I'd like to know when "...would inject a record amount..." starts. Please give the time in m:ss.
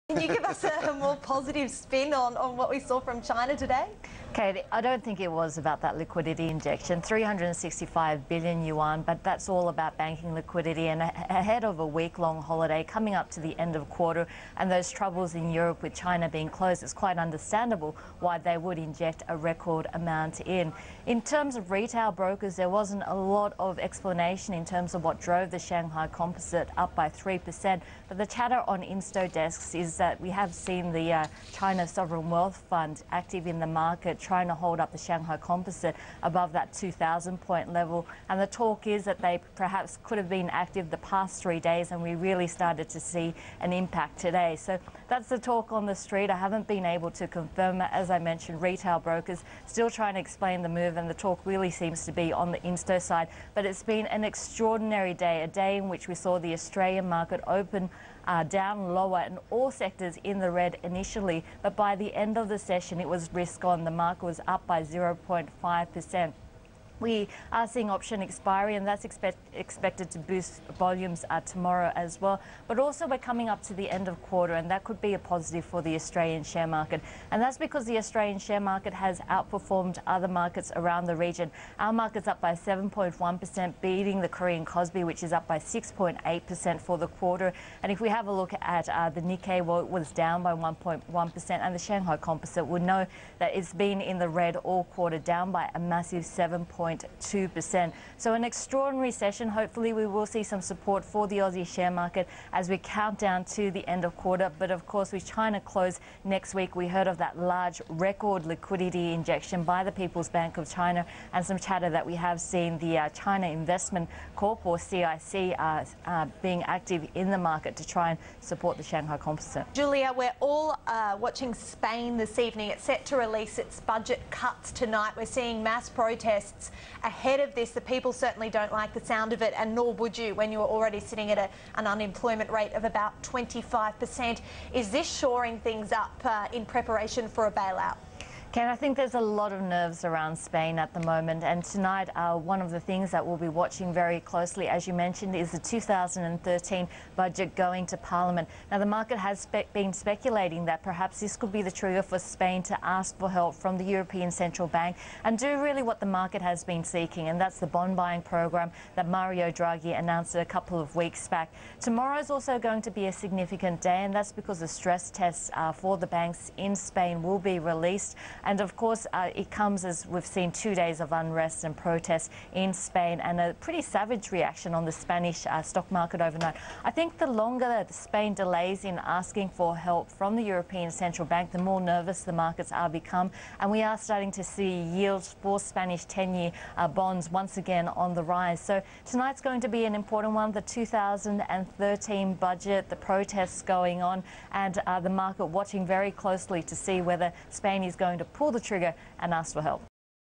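0:18.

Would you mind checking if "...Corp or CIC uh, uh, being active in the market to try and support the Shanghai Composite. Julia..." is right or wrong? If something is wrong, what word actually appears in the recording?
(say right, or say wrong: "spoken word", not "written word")
right.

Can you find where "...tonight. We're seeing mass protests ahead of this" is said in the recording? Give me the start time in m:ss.
2:04.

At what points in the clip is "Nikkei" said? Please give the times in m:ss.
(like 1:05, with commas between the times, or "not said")
1:29.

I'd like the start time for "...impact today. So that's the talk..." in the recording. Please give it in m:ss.
0:43.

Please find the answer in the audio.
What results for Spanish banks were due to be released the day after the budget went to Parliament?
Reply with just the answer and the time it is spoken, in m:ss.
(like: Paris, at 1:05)
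Stress tests, at 2:44.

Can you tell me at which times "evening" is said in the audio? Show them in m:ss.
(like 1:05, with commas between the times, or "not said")
2:02.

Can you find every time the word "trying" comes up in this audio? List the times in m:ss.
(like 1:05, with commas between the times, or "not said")
0:34, 0:49.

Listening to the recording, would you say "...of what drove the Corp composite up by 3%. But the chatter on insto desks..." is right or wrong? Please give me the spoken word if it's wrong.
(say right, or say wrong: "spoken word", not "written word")
wrong: "Shanghai", not "Corp".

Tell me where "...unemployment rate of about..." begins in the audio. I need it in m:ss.
2:11.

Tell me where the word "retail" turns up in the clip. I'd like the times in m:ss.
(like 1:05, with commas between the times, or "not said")
0:21, 0:48.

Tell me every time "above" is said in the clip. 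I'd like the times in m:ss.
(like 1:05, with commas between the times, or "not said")
0:36.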